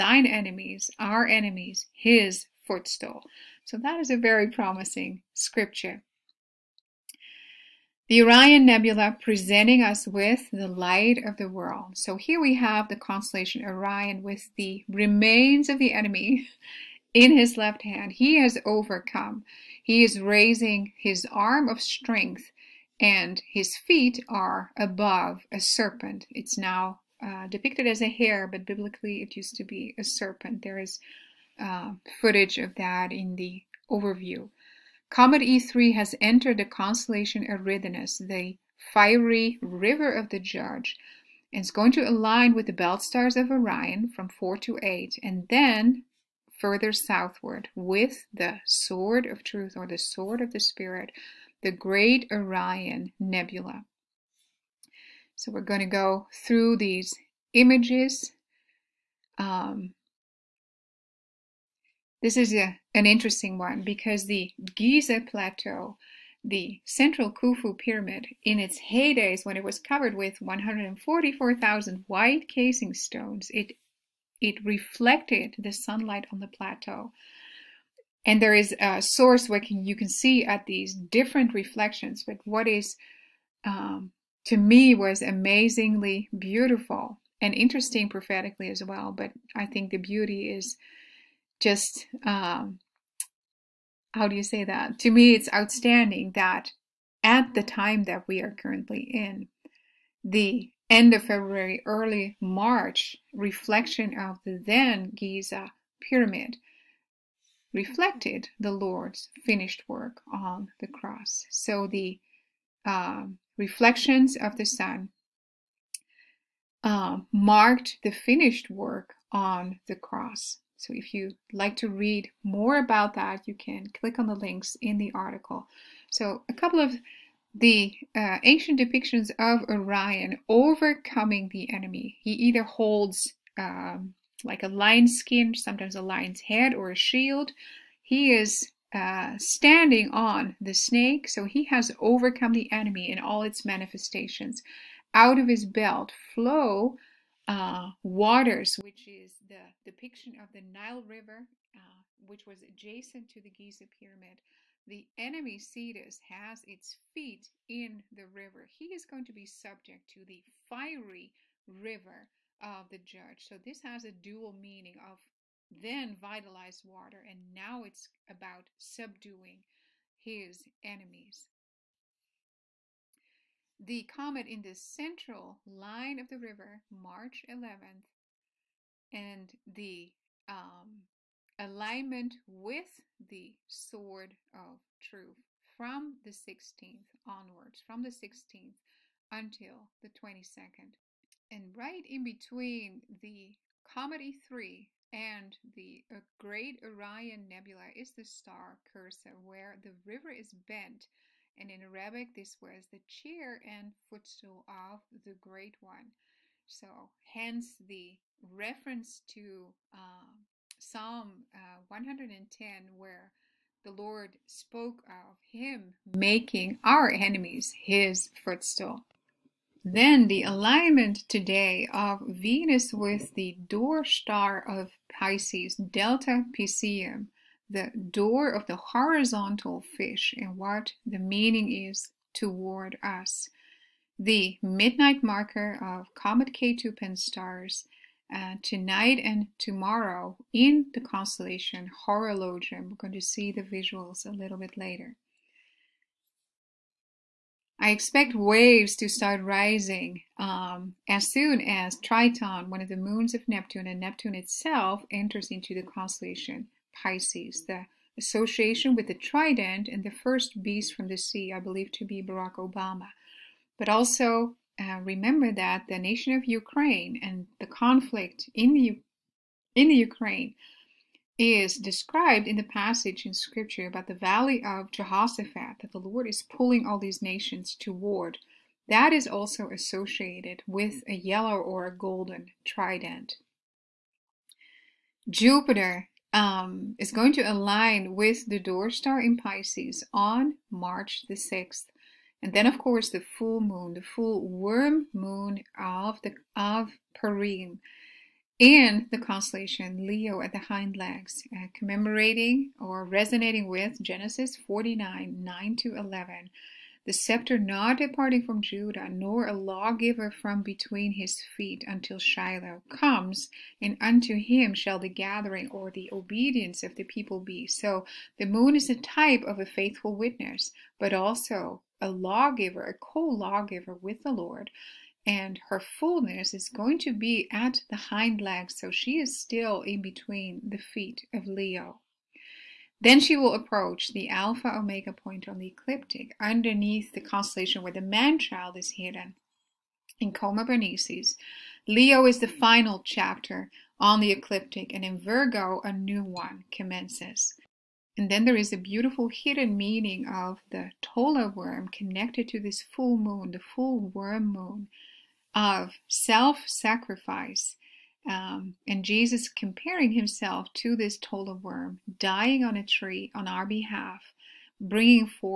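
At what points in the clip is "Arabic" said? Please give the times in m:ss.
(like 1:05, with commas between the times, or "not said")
3:21.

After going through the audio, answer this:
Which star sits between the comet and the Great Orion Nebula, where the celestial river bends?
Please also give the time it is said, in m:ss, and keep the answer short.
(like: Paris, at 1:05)
Cursa, at 3:18.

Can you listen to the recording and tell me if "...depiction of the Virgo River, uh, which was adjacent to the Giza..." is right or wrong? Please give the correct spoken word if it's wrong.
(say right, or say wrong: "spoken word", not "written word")
wrong: "Nile", not "Virgo".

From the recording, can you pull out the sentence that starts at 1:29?
But I think the beauty is just um, how do you say that?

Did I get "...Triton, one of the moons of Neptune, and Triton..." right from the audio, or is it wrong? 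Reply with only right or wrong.
wrong.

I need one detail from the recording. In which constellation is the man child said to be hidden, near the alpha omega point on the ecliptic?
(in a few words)
Coma Berenices.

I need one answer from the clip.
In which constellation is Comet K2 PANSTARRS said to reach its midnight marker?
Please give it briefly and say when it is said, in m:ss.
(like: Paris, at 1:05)
Horologium, at 4:02.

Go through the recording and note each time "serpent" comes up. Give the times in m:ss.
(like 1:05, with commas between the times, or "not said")
0:25, 0:30.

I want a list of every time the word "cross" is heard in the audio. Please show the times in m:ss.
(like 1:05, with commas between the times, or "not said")
1:50, 1:59.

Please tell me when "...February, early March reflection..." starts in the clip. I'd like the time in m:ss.
1:41.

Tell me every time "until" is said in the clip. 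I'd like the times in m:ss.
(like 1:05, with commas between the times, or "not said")
3:09, 5:11.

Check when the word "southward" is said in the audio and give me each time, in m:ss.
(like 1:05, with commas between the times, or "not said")
0:46.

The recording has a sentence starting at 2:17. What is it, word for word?
He is uh, standing on the snake, so he has overcome the enemy in all its manifestations.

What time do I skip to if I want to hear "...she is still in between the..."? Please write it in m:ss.
5:28.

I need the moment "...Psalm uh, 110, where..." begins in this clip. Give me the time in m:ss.
3:30.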